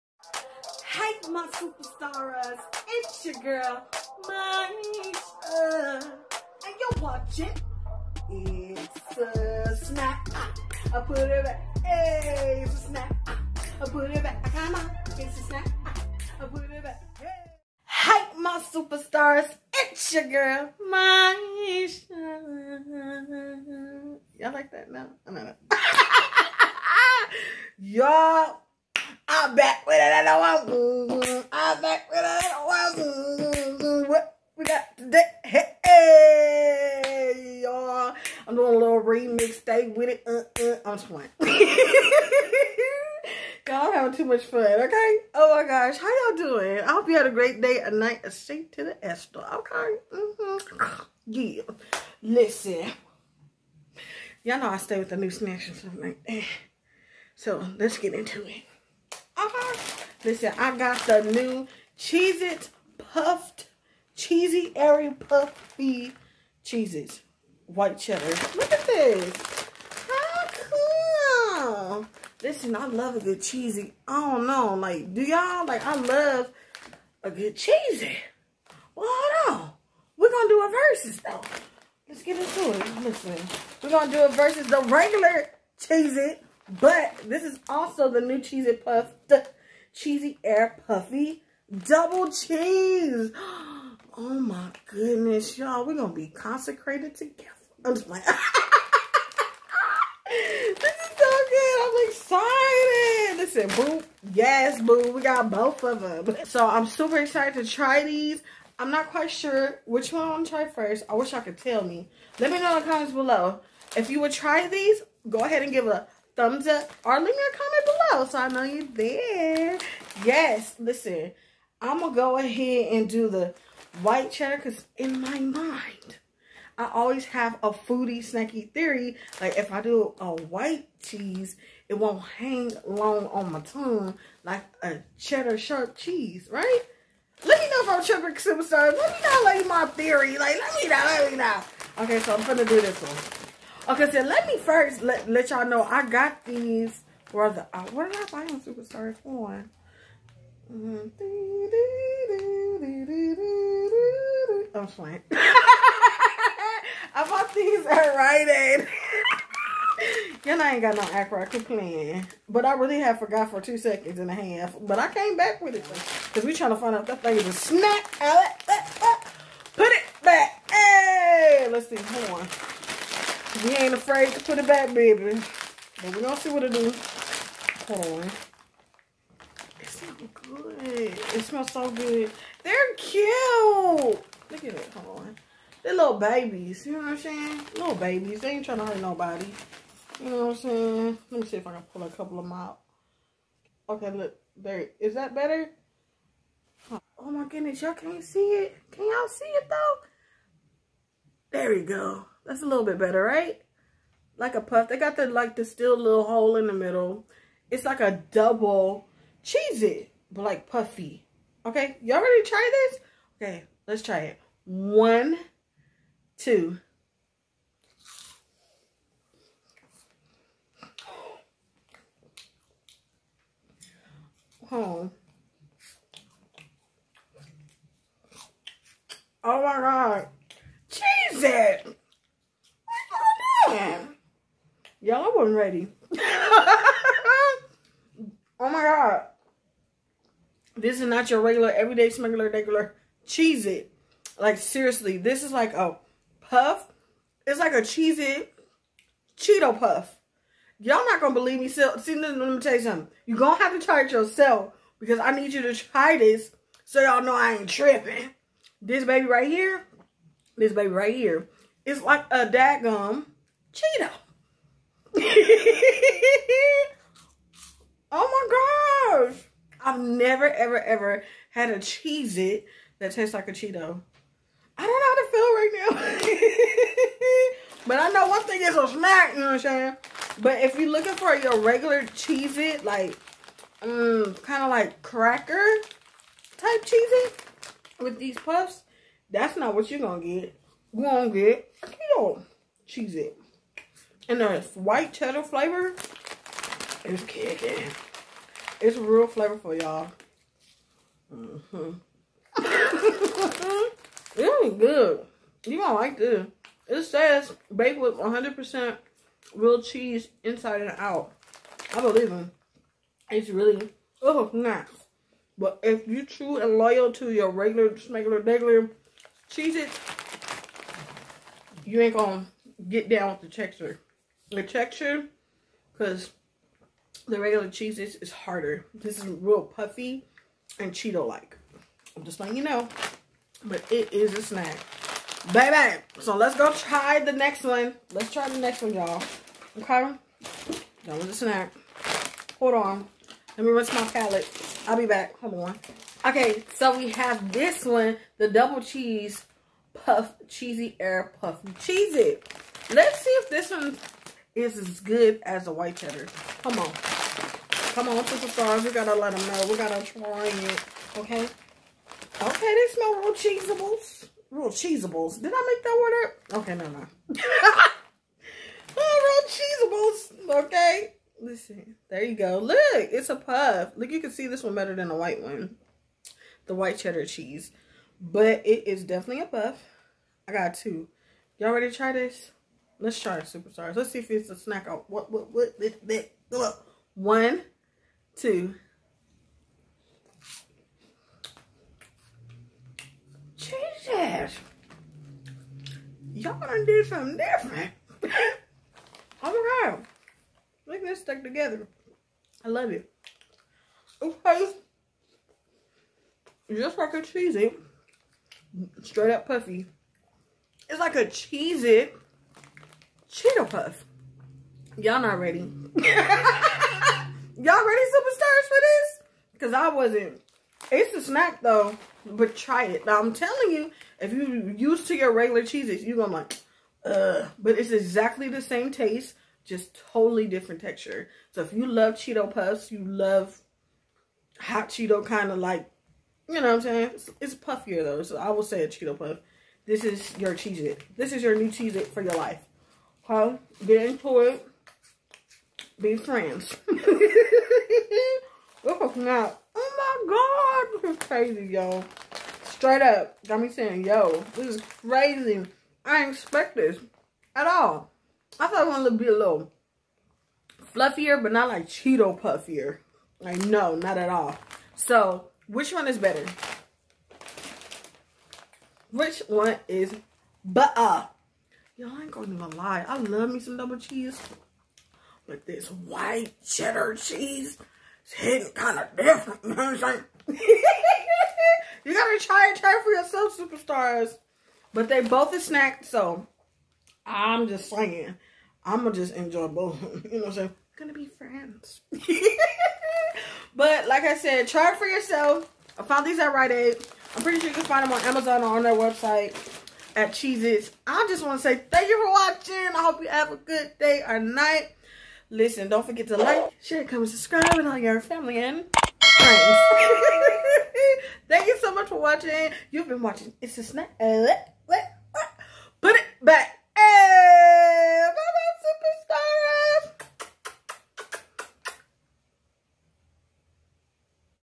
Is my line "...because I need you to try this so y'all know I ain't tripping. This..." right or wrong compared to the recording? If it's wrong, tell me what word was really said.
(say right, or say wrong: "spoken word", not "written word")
right.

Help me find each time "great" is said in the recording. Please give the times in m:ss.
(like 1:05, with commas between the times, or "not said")
0:47.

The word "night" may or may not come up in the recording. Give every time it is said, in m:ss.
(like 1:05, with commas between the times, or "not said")
0:47, 8:24.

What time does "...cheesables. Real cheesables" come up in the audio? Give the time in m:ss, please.
6:03.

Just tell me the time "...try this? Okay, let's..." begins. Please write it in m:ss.
3:32.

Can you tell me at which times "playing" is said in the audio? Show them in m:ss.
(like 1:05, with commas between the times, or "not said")
0:41, 2:34.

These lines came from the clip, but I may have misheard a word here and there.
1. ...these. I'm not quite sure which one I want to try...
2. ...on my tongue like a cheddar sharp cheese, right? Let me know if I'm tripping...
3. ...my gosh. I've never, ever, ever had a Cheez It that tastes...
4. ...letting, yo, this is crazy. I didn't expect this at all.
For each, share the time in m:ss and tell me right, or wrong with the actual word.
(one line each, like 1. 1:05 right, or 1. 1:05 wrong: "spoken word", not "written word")
1. 1:48 right
2. 2:13 right
3. 4:28 right
4. 7:33 wrong: "saying", not "letting".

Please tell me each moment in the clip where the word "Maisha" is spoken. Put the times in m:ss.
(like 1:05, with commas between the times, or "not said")
0:04, 0:20.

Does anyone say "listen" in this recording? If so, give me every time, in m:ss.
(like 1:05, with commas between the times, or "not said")
0:52, 1:00, 1:12, 1:23, 1:43, 2:00, 6:11, 8:25.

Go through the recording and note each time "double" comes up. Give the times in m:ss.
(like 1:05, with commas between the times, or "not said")
1:31, 3:28, 5:48, 7:53.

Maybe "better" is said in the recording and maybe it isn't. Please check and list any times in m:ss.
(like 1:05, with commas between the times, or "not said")
3:15, 3:22, 6:14, 7:46, 7:50.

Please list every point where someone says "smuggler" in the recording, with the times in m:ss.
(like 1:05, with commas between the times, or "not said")
4:02.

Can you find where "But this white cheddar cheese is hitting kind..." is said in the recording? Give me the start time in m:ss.
7:55.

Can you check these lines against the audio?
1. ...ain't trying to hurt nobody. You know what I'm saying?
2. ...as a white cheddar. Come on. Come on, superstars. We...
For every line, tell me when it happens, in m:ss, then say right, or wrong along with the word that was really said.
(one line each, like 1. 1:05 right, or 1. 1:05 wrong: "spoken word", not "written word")
1. 3:08 right
2. 5:55 right.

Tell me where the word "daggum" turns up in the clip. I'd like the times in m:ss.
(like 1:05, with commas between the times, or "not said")
4:22.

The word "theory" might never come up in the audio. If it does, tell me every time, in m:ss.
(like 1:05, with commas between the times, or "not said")
2:08, 2:19.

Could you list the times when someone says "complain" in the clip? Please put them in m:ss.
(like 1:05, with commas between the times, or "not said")
2:41.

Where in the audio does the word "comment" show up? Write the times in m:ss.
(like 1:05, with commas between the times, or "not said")
1:52, 1:57, 8:27.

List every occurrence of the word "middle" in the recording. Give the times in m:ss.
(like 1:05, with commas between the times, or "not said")
3:26.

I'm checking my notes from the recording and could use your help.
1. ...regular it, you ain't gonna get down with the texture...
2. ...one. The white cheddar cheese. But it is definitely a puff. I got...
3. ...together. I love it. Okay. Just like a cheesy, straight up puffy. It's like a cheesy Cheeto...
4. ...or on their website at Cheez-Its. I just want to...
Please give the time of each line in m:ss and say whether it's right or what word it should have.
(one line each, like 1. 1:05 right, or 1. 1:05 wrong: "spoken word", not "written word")
1. 5:18 right
2. 6:15 right
3. 6:41 right
4. 8:18 right.